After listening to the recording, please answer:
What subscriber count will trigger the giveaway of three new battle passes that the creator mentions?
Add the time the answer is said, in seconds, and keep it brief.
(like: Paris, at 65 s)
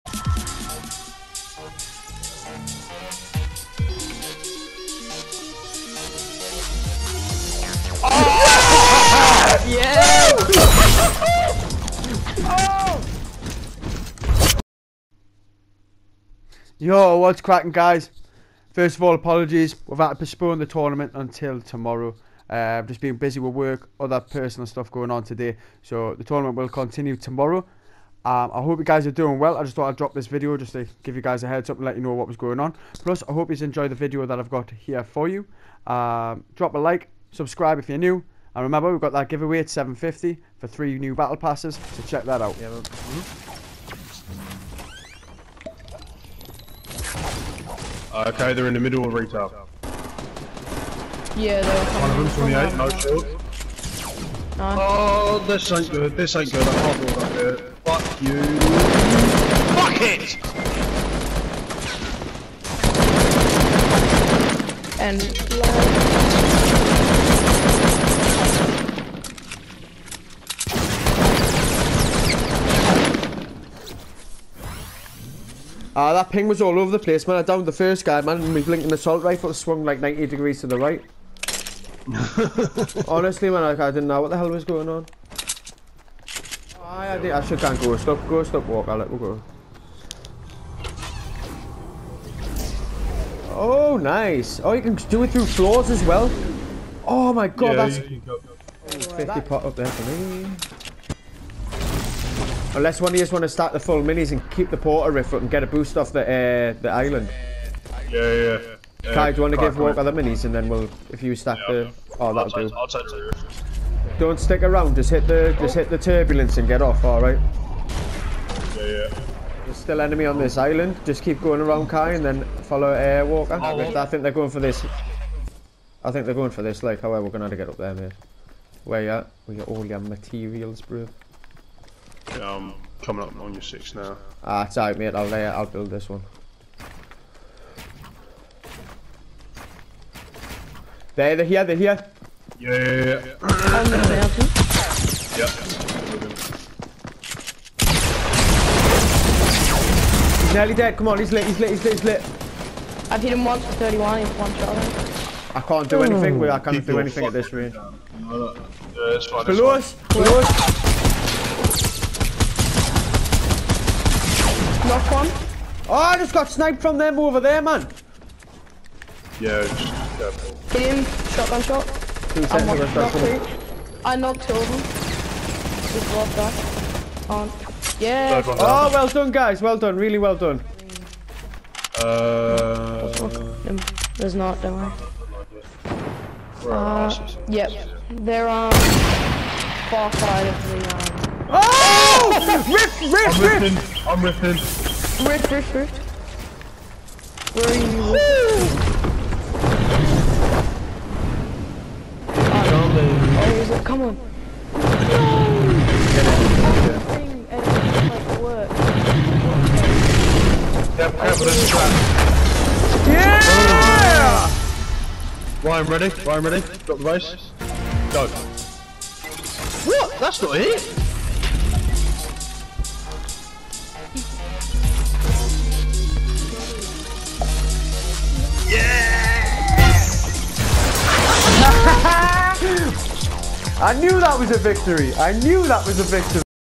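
750, at 39 s.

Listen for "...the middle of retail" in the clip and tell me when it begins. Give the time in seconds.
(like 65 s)
48 s.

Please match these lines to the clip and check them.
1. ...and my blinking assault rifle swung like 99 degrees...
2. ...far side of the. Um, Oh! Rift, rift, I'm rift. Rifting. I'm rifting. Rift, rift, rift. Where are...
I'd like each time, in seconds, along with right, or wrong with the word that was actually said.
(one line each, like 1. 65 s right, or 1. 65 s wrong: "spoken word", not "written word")
1. 78 s wrong: "90", not "99"
2. 189 s right.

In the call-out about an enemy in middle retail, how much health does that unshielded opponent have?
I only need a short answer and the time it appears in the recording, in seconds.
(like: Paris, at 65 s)
28, at 52 s.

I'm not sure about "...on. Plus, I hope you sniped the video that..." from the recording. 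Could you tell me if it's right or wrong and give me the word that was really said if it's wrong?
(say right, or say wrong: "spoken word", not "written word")
wrong: "enjoyed", not "sniped".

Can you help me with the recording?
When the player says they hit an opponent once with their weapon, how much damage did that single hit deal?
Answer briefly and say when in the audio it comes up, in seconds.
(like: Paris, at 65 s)
31, at 153 s.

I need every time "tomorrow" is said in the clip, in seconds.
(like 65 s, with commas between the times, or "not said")
21 s, 27 s.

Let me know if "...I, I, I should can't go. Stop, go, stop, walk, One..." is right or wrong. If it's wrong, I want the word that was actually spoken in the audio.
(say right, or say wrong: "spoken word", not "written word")
wrong: "Alec", not "One".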